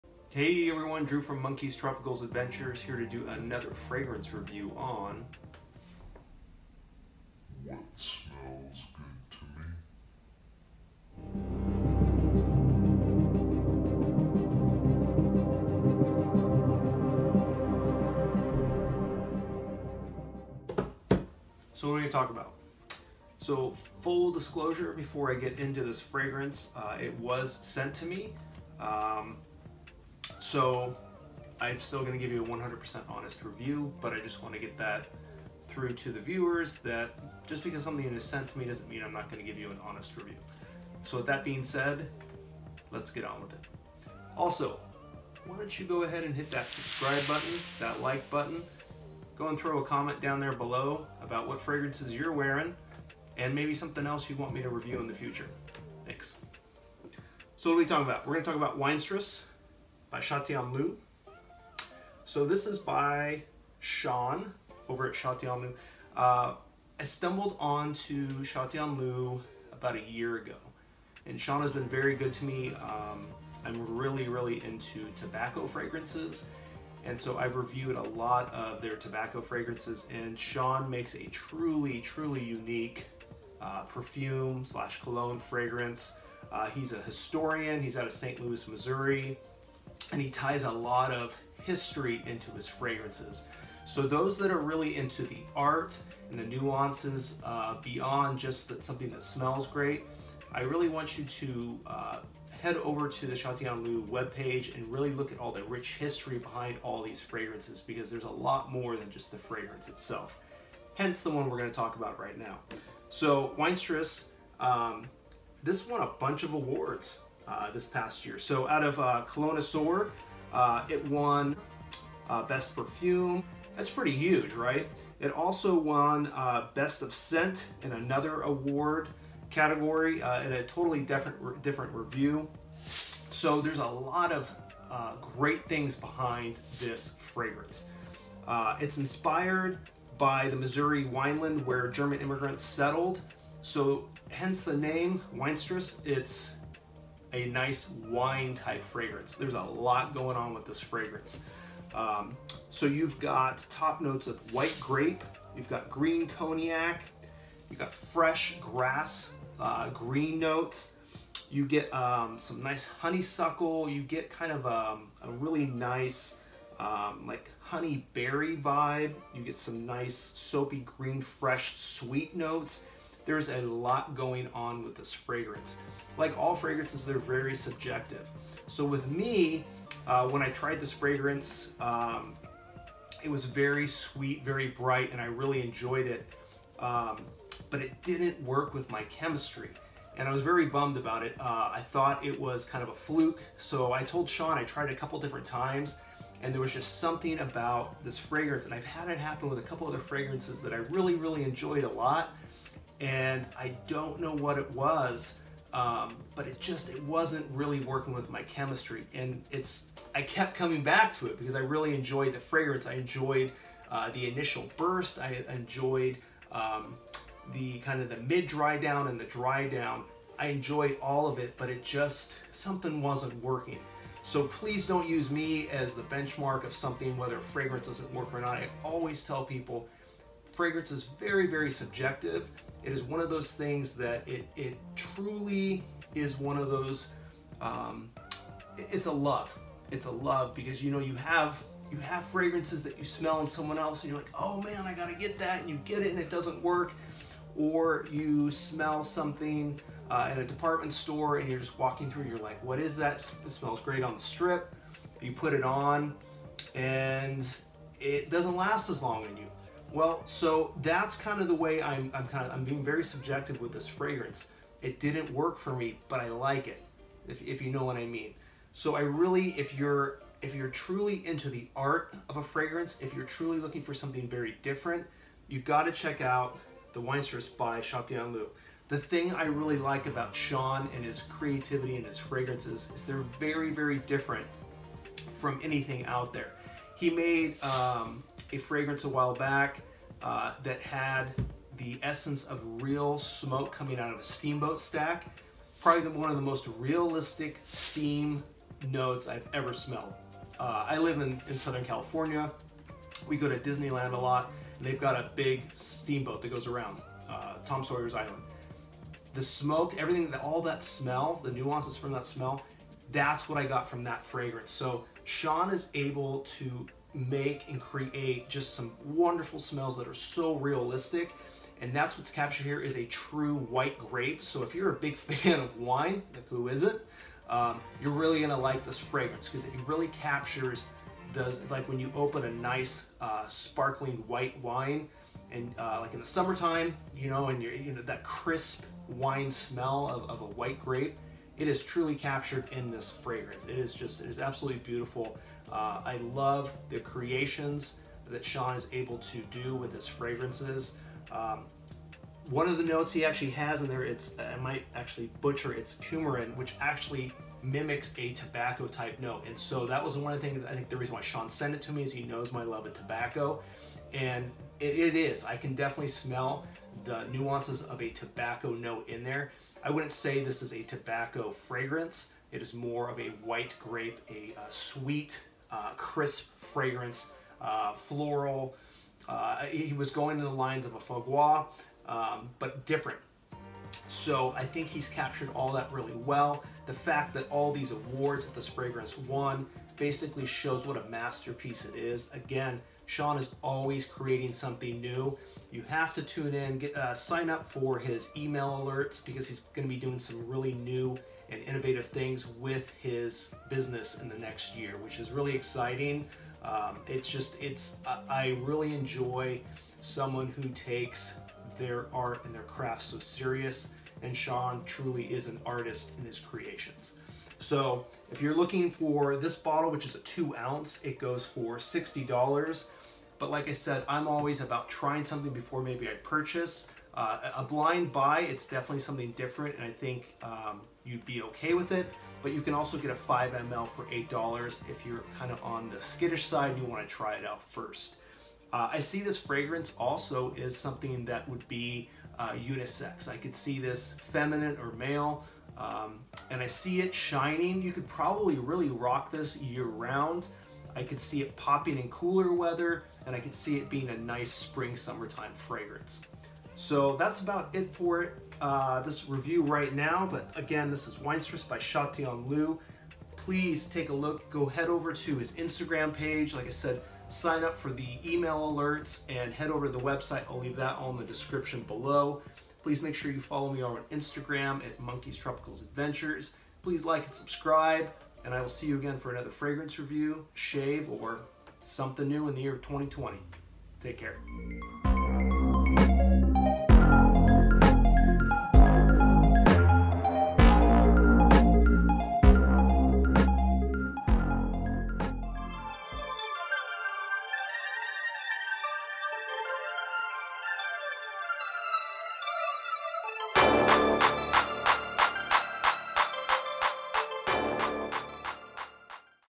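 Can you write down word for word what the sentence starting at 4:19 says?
Well, so that's kind of the way I'm, I'm kind of, I'm being very subjective with this fragrance.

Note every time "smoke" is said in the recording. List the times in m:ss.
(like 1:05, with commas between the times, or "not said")
4:53, 5:09.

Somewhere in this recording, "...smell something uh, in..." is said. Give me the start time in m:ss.
4:08.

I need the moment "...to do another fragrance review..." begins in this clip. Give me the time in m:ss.
0:02.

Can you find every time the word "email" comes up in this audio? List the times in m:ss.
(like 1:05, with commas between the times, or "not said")
6:38, 7:48.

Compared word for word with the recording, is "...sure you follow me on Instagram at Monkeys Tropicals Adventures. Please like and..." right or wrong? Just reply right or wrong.
right.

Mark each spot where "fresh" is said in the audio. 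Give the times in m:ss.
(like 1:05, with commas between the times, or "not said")
2:37, 2:51.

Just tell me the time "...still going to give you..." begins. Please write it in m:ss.
0:31.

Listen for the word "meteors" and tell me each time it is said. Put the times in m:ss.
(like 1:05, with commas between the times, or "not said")
not said.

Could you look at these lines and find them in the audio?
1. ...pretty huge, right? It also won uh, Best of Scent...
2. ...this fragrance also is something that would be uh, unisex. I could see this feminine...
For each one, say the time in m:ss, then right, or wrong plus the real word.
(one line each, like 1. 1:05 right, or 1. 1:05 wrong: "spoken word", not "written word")
1. 2:03 right
2. 7:19 right.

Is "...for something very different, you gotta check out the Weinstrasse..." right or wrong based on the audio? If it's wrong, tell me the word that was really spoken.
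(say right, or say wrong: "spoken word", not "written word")
right.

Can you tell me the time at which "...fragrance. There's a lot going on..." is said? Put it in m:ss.
2:28.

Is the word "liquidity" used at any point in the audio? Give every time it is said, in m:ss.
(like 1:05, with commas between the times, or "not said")
not said.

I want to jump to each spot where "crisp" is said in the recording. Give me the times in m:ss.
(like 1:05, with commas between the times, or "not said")
5:38, 6:15.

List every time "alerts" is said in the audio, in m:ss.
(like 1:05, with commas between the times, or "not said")
6:38, 7:48.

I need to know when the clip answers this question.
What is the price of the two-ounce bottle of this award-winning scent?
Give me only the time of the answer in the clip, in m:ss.
7:01.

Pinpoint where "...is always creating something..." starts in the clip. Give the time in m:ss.
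6:33.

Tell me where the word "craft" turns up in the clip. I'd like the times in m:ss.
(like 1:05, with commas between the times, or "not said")
6:52.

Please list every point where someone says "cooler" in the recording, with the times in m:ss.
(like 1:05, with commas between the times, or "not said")
7:32.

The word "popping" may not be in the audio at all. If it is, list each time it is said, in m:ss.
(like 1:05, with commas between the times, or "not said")
7:31.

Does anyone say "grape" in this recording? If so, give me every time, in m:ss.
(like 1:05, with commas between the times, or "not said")
2:34, 5:23, 5:40, 6:13.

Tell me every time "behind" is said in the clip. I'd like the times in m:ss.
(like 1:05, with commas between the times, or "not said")
1:46, 2:15.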